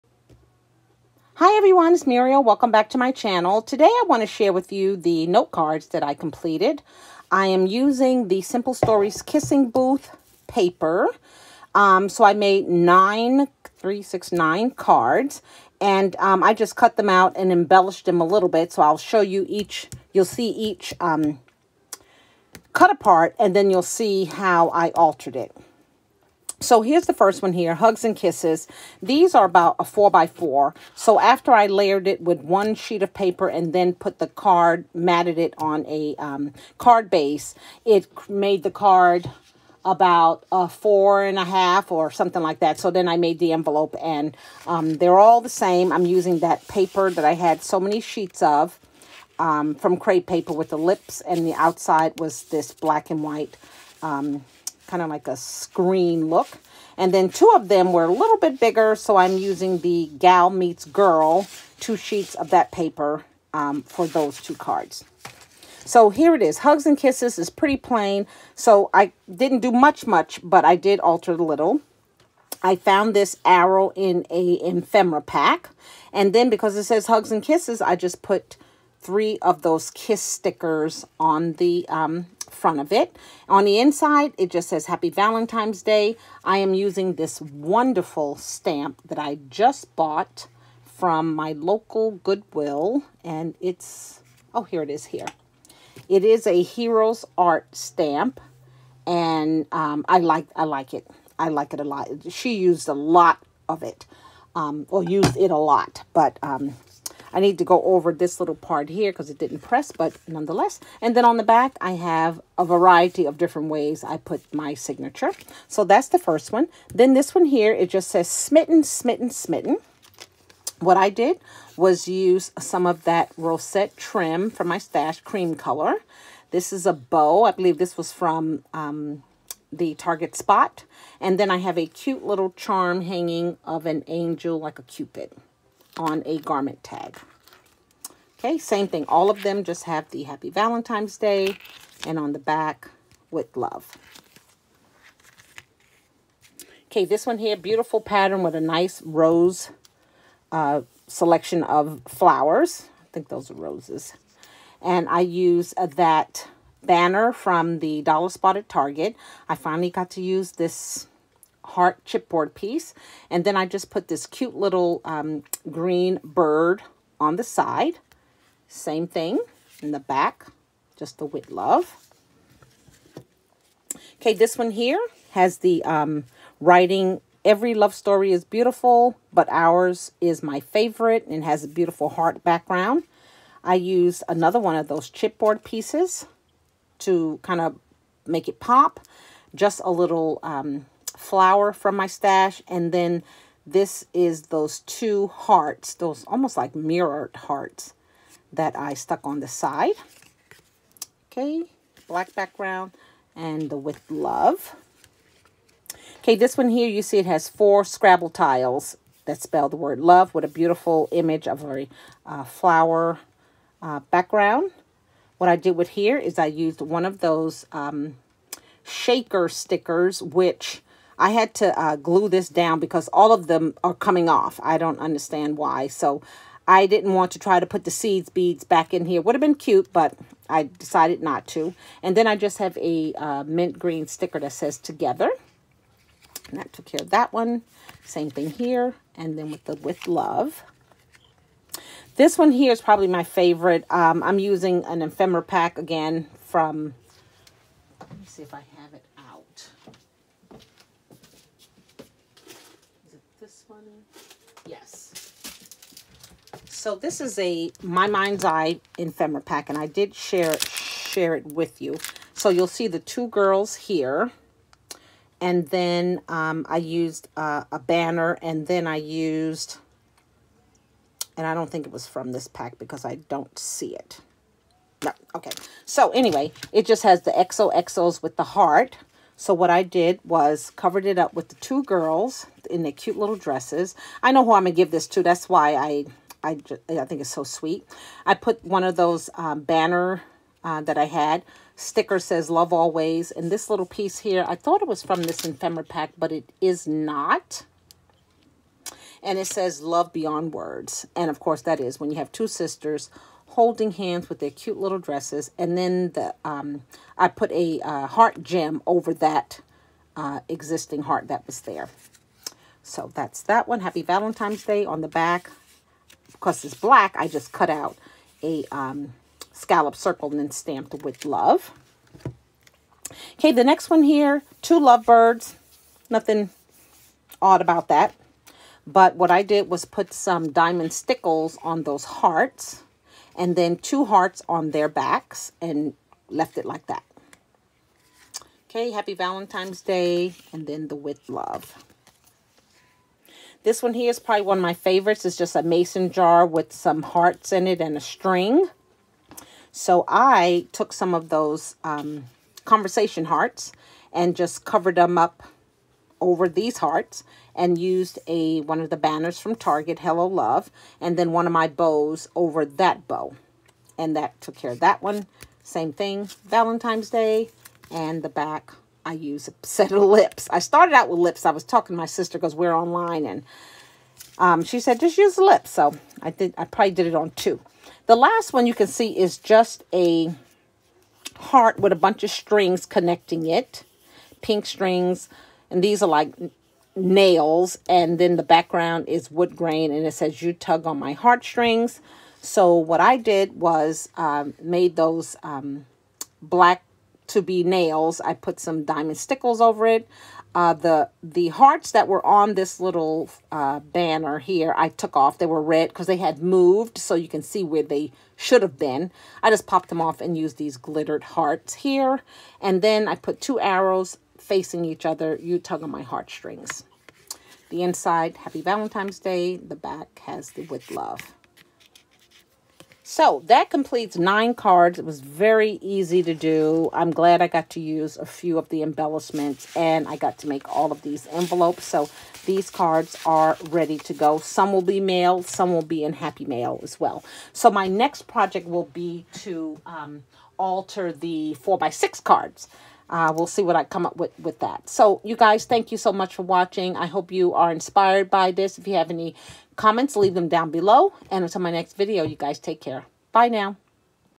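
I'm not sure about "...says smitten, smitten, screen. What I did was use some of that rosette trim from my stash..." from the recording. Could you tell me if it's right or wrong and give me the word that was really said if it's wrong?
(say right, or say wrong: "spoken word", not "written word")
wrong: "smitten", not "screen".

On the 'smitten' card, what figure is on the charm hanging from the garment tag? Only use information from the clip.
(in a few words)
cupid.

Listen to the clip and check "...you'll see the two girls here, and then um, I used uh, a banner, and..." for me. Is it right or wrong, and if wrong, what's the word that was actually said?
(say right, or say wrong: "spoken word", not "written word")
right.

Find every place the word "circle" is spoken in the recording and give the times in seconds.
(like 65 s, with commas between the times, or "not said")
319 s.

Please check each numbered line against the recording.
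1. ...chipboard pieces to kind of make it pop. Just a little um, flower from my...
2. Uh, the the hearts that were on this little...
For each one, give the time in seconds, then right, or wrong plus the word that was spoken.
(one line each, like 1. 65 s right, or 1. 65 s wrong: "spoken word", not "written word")
1. 185 s right
2. 400 s right.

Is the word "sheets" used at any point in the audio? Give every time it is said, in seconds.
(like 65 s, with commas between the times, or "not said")
32 s, 47 s, 61 s.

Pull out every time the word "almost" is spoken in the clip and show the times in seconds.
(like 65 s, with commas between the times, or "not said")
196 s.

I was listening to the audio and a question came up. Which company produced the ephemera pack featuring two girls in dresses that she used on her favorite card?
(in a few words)
My Mind's Eye.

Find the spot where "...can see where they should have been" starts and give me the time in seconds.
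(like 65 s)
407 s.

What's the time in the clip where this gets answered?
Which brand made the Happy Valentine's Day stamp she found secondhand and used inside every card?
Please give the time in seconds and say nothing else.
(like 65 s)
96 s.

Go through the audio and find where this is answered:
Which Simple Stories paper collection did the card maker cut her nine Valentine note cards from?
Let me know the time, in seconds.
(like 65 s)
9 s.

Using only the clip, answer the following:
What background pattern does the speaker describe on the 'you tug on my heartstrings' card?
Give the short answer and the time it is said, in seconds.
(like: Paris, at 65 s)
wood grain, at 389 s.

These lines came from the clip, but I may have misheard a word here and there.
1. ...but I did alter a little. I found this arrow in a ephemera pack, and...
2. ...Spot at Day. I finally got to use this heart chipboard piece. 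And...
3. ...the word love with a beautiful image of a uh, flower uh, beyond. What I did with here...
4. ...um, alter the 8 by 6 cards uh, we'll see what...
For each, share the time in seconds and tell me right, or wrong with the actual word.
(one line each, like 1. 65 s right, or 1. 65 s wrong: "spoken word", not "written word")
1. 70 s right
2. 158 s wrong: "Target", not "Day"
3. 209 s wrong: "background", not "beyond"
4. 439 s wrong: "4", not "8".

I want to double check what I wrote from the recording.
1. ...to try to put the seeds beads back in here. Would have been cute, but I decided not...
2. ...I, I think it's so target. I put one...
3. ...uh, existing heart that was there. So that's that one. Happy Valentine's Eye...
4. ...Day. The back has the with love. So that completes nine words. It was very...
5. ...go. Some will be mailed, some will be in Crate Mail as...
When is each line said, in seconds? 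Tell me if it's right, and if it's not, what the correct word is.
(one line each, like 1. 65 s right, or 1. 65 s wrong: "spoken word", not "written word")
1. 227 s right
2. 286 s wrong: "sweet", not "target"
3. 310 s wrong: "Day", not "Eye"
4. 419 s wrong: "cards", not "words"
5. 434 s wrong: "Happy", not "Crate".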